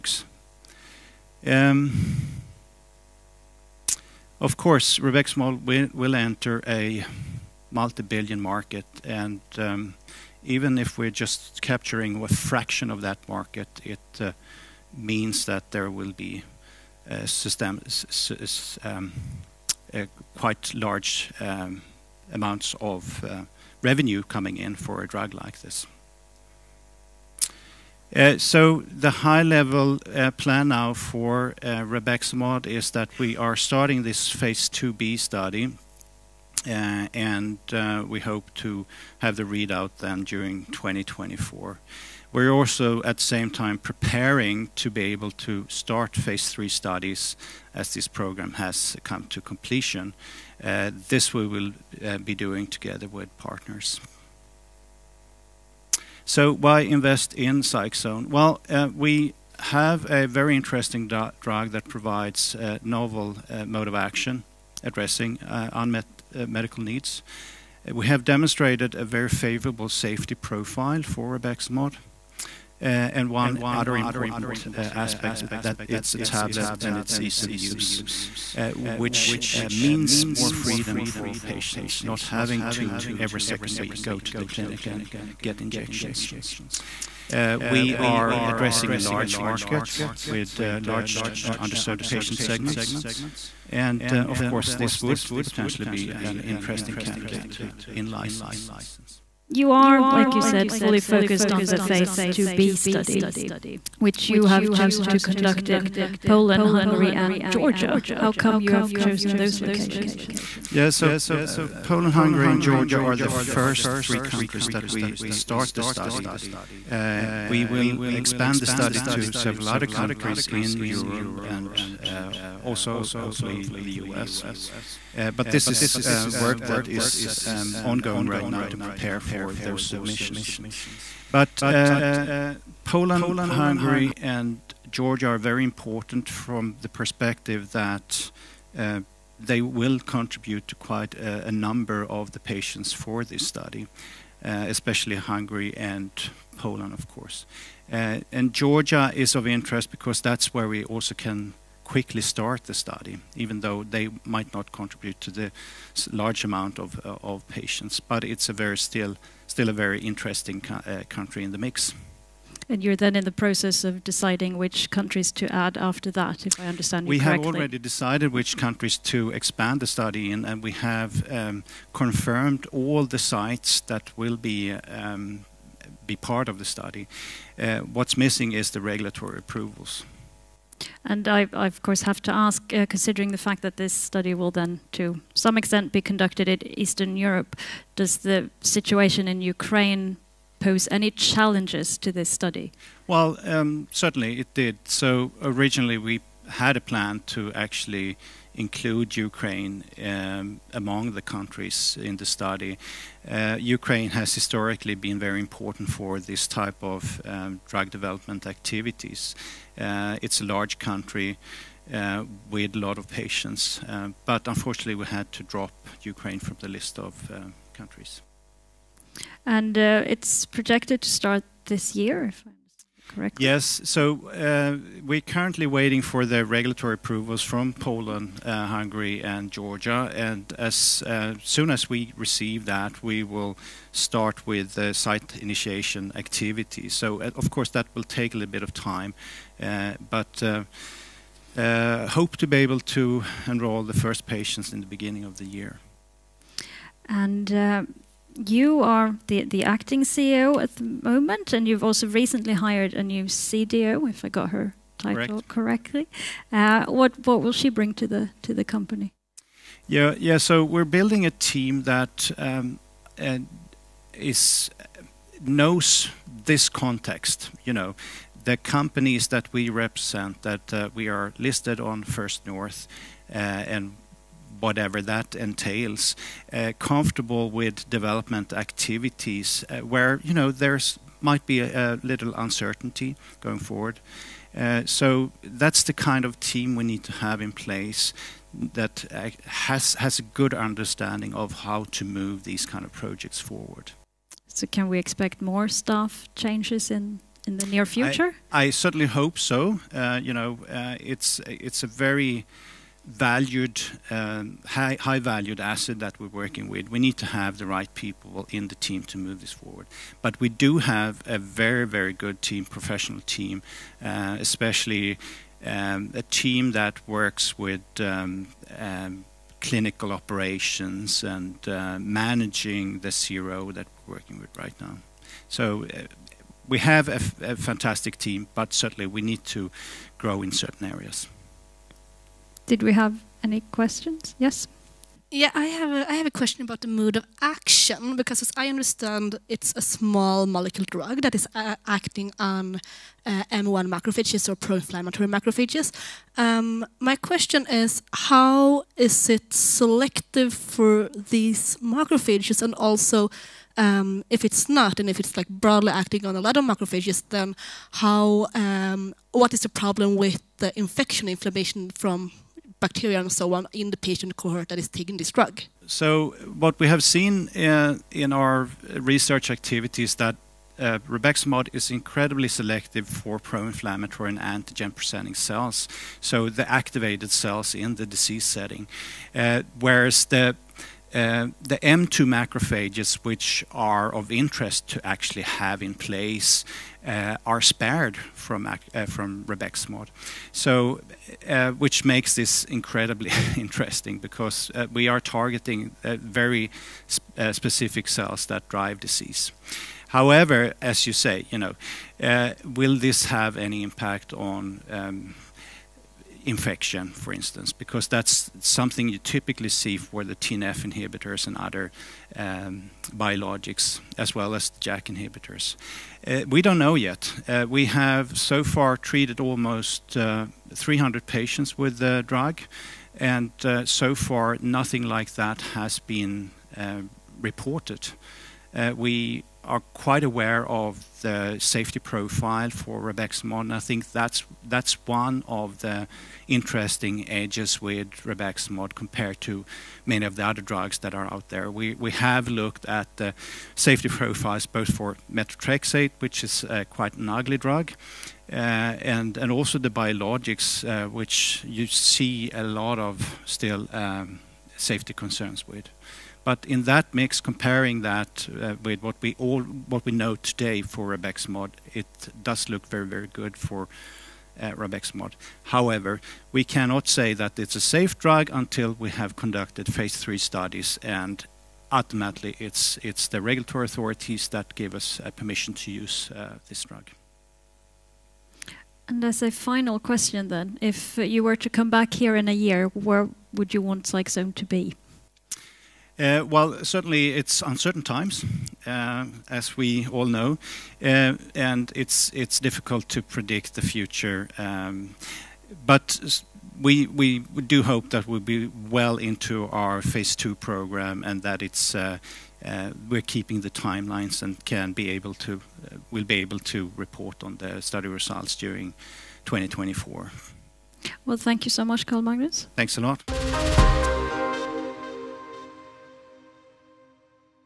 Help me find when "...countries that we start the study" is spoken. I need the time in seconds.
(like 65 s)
114 s.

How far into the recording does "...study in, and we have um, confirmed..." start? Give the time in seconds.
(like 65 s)
169 s.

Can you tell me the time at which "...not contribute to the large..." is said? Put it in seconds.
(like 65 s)
154 s.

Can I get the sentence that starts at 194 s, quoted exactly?
So originally we had a plan to actually include Ukraine um, among the countries in the study.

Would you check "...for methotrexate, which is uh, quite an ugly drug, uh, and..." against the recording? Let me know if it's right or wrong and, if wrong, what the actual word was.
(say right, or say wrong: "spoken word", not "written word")
right.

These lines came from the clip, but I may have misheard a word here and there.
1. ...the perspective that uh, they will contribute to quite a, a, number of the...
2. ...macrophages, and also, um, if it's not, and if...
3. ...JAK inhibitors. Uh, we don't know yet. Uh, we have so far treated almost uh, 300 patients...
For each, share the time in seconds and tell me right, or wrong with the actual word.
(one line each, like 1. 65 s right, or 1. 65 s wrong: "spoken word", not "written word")
1. 136 s right
2. 351 s right
3. 414 s right.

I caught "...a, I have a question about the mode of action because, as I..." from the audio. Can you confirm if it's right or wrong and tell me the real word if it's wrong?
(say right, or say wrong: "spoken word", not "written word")
right.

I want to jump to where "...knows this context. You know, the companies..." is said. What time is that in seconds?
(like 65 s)
265 s.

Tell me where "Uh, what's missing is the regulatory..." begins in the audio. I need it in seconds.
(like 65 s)
177 s.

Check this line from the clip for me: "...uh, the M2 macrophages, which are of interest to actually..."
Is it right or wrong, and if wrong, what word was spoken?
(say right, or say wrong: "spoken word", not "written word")
right.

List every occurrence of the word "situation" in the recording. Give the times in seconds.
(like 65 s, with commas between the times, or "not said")
188 s.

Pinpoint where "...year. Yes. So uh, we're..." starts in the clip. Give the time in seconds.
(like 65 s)
221 s.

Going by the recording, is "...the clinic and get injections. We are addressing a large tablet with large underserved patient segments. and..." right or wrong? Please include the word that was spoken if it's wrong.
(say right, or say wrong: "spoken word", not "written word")
wrong: "market", not "tablet".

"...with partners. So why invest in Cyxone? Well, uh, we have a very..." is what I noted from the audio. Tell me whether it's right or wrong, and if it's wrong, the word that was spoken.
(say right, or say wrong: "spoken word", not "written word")
right.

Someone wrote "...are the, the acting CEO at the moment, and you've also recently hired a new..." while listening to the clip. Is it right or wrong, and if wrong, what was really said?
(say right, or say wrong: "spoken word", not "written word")
right.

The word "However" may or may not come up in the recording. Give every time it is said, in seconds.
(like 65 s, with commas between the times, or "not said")
400 s, 465 s.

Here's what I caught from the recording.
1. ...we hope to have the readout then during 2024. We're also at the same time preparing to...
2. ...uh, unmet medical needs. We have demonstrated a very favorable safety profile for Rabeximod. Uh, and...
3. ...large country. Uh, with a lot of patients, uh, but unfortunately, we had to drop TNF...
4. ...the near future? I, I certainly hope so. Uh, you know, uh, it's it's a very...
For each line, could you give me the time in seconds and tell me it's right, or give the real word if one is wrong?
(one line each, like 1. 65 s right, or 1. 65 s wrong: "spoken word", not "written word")
1. 38 s right
2. 65 s right
3. 210 s wrong: "Ukraine", not "TNF"
4. 297 s right.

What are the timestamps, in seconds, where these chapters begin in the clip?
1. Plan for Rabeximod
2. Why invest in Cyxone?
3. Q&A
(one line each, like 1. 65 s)
1. 27 s
2. 55 s
3. 99 s.